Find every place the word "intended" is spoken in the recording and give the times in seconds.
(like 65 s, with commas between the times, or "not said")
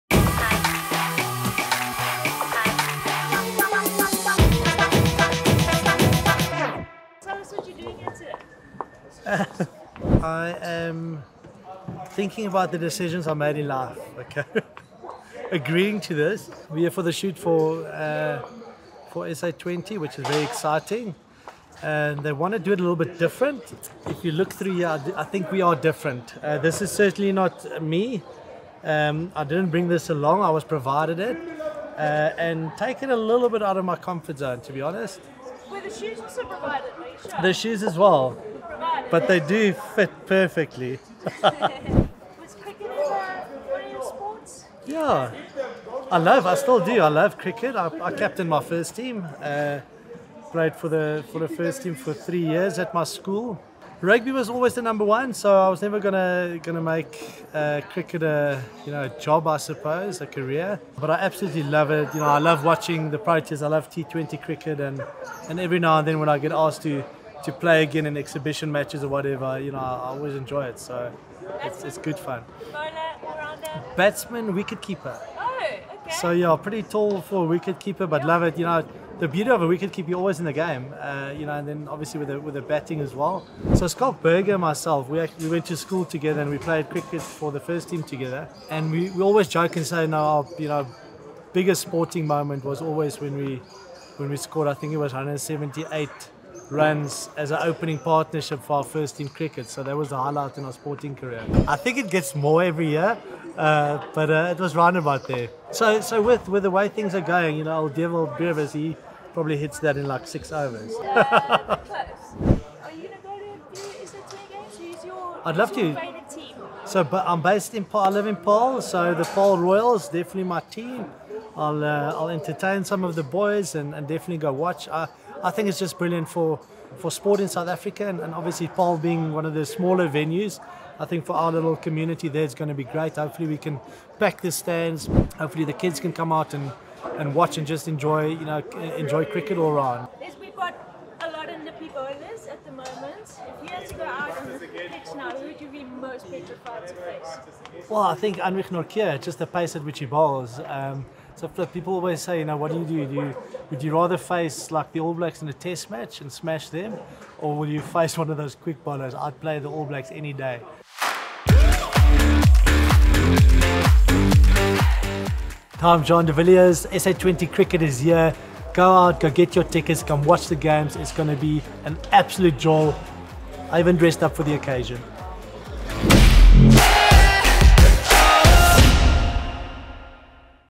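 not said.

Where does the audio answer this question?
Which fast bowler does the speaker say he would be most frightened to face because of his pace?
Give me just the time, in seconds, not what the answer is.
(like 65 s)
148 s.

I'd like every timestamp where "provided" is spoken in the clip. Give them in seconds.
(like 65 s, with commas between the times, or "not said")
30 s, 36 s.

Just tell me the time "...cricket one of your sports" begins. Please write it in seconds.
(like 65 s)
42 s.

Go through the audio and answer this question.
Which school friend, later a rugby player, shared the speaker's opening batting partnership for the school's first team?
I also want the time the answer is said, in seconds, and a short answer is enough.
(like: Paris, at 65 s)
Schalk Burger, at 83 s.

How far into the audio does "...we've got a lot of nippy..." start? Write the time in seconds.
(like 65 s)
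140 s.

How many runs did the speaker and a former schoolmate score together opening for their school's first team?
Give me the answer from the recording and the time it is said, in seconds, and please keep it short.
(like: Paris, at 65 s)
178, at 95 s.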